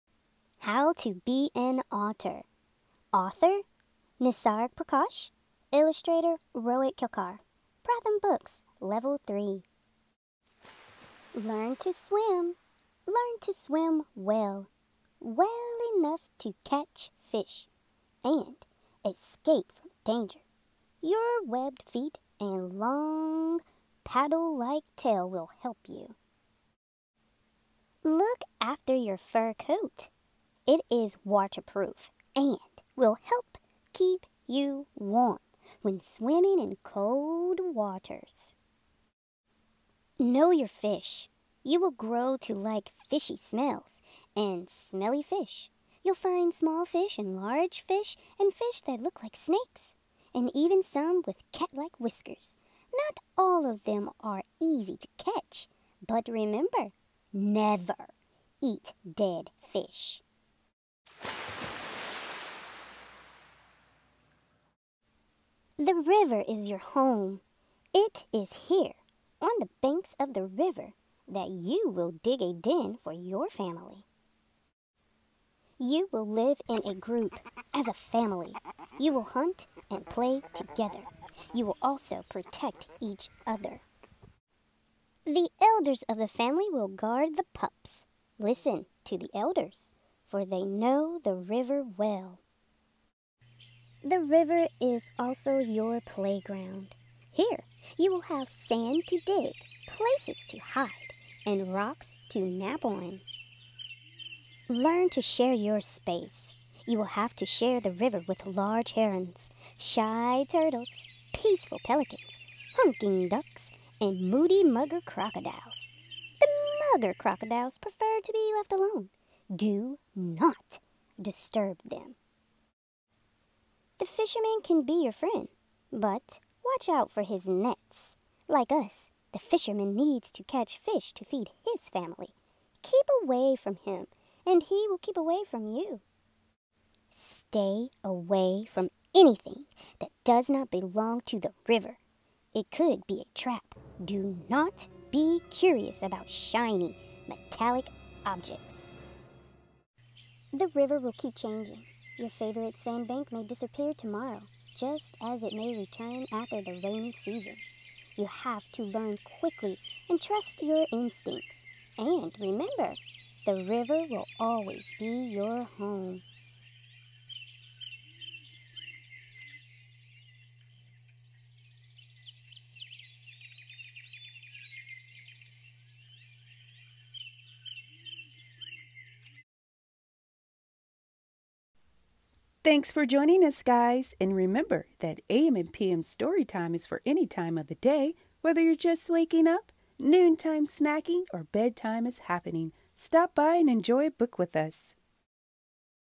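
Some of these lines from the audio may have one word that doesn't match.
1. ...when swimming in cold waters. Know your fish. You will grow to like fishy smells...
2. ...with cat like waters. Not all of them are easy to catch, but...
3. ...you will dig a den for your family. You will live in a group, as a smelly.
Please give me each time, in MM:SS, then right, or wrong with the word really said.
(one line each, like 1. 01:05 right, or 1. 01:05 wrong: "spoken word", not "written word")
1. 00:35 right
2. 00:51 wrong: "whiskers", not "waters"
3. 01:11 wrong: "family", not "smelly".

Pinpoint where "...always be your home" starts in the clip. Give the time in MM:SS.
02:44.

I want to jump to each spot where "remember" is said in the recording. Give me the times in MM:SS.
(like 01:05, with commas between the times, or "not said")
00:56, 02:42, 03:04.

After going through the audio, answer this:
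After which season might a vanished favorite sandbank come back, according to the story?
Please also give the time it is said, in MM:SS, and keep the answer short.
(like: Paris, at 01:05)
rainy season, at 02:36.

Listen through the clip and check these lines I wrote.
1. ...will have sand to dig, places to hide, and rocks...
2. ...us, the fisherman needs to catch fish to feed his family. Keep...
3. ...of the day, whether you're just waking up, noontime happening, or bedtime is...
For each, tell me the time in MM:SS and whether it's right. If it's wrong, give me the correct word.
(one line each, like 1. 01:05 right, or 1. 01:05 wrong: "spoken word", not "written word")
1. 01:38 right
2. 02:08 right
3. 03:07 wrong: "snacking", not "happening".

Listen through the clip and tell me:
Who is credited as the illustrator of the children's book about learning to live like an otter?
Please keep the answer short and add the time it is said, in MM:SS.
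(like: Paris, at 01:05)
Rohit Kelkar, at 00:06.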